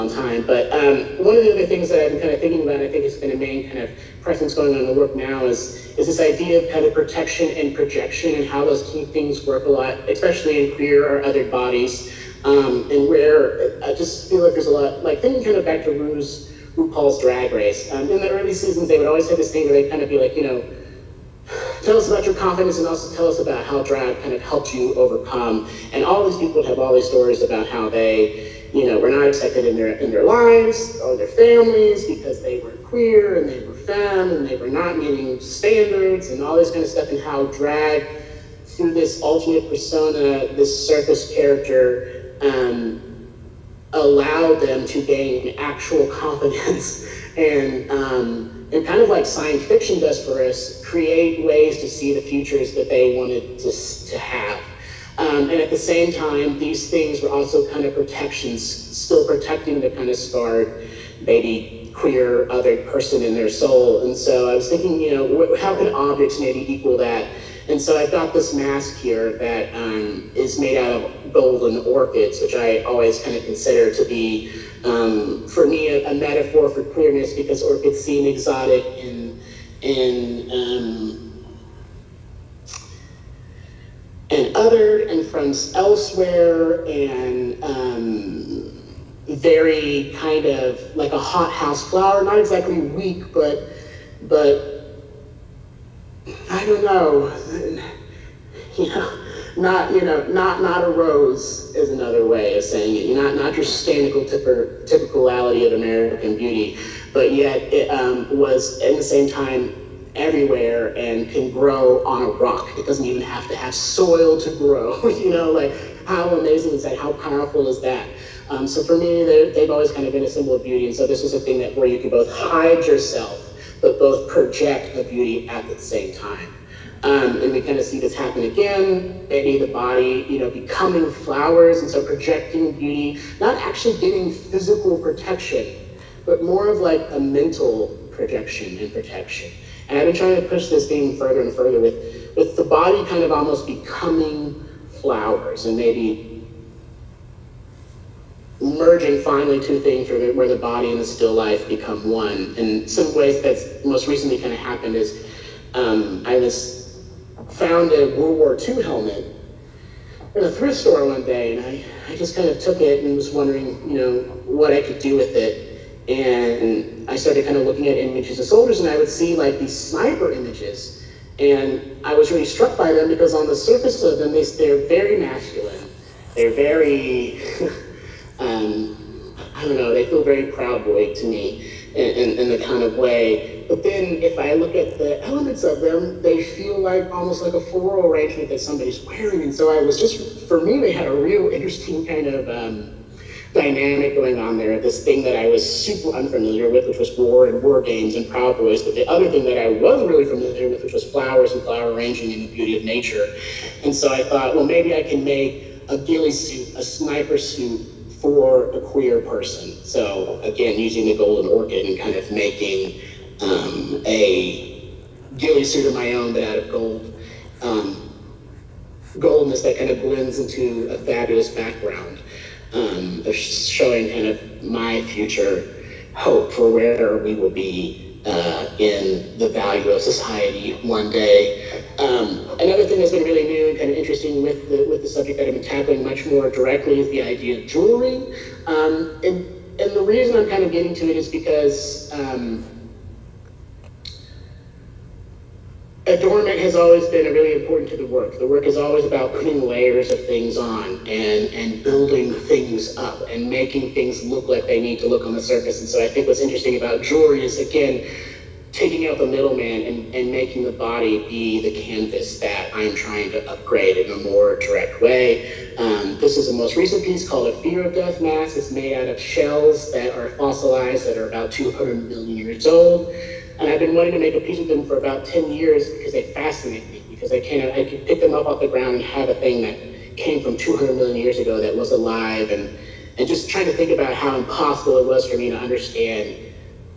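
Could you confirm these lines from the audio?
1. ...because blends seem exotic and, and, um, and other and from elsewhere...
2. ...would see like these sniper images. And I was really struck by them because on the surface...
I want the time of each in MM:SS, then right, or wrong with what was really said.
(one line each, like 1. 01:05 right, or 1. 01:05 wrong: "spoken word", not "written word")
1. 01:17 wrong: "orchids", not "blends"
2. 02:48 right.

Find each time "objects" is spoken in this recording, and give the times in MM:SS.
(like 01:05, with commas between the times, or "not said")
01:05.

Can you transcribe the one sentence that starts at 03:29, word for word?
So again, using the golden orchid and kind of making um, a ghillie suit of my own, but out of gold.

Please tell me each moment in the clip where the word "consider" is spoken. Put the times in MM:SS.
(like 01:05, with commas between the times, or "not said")
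01:13.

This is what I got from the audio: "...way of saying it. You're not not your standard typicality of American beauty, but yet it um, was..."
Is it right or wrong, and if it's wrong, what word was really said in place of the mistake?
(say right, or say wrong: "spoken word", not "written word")
right.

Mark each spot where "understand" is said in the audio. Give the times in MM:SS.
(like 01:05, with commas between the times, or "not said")
04:45.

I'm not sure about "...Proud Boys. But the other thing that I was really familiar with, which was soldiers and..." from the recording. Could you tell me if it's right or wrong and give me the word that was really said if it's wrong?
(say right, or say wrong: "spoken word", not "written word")
wrong: "flowers", not "soldiers".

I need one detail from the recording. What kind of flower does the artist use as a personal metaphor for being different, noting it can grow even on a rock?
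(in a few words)
Golden orchids.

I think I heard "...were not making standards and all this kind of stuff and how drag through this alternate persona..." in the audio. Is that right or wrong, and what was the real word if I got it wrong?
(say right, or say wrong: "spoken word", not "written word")
wrong: "meeting", not "making".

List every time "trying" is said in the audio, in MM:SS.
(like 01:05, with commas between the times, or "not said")
02:20, 04:22, 04:43.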